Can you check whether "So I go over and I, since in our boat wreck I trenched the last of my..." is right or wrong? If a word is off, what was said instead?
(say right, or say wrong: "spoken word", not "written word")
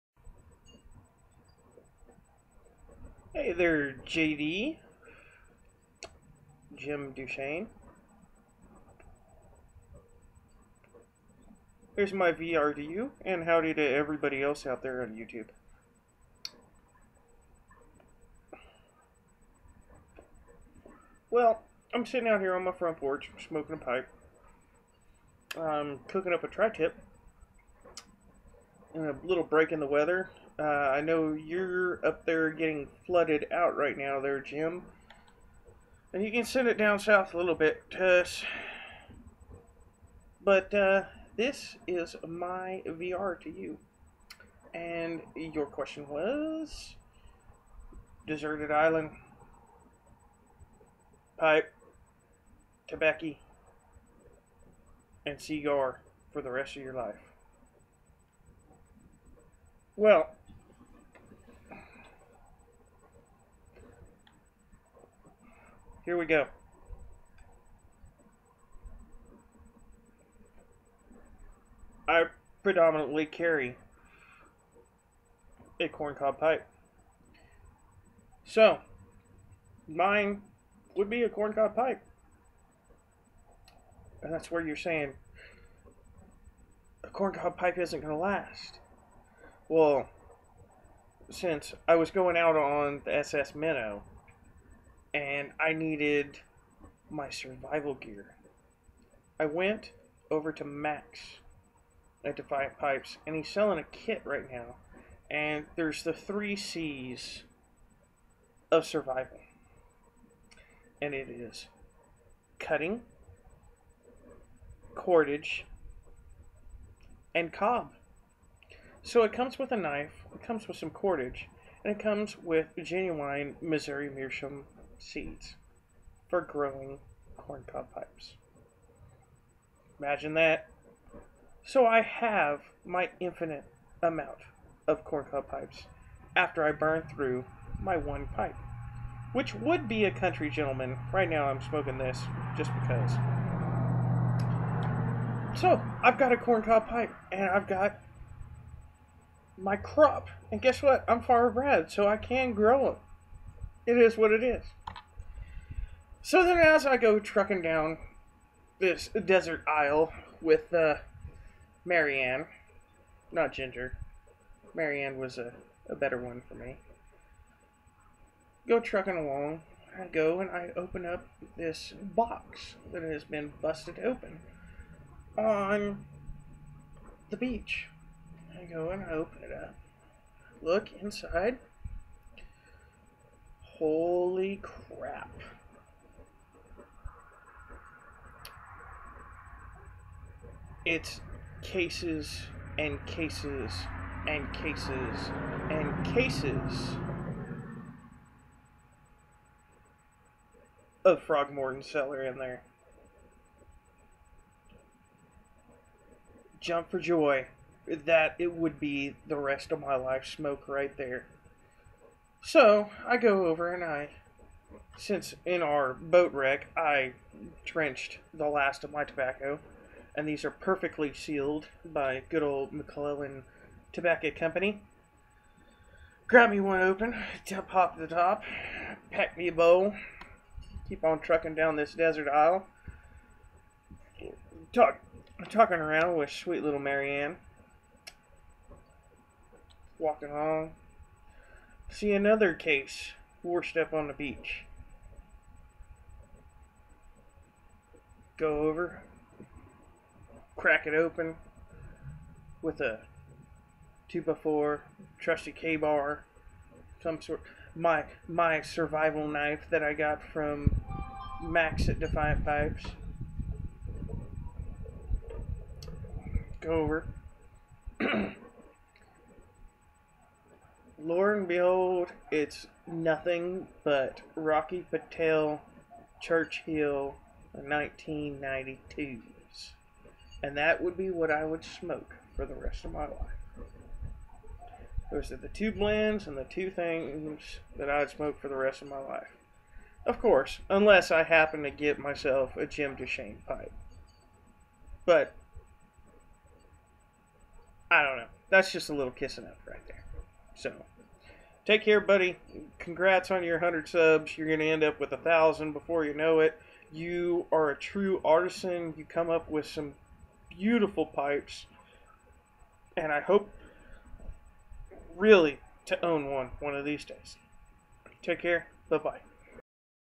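right.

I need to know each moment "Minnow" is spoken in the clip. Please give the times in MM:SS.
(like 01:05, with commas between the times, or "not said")
01:33.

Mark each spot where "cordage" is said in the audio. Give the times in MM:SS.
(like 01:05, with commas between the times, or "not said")
01:54, 02:00.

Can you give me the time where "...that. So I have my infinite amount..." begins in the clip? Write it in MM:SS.
02:10.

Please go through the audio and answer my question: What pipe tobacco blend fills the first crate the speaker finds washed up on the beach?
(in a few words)
Frog Morton Cellar.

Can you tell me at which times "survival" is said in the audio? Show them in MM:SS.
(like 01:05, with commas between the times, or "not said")
01:37, 01:48, 04:18.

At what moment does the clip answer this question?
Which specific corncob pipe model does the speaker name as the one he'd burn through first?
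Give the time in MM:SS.
02:20.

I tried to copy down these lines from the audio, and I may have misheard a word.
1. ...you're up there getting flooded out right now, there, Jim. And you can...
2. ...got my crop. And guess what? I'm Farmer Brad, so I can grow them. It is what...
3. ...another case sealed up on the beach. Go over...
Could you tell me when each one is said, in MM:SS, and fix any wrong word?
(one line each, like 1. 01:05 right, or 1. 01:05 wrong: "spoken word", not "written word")
1. 00:31 right
2. 02:27 right
3. 04:02 wrong: "washed", not "sealed".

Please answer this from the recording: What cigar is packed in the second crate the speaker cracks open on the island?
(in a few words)
Rocky Patel Churchill 1992.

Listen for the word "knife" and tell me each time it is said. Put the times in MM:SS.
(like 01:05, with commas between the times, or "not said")
01:59, 04:19.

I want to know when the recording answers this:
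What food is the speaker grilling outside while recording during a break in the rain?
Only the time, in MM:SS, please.
00:26.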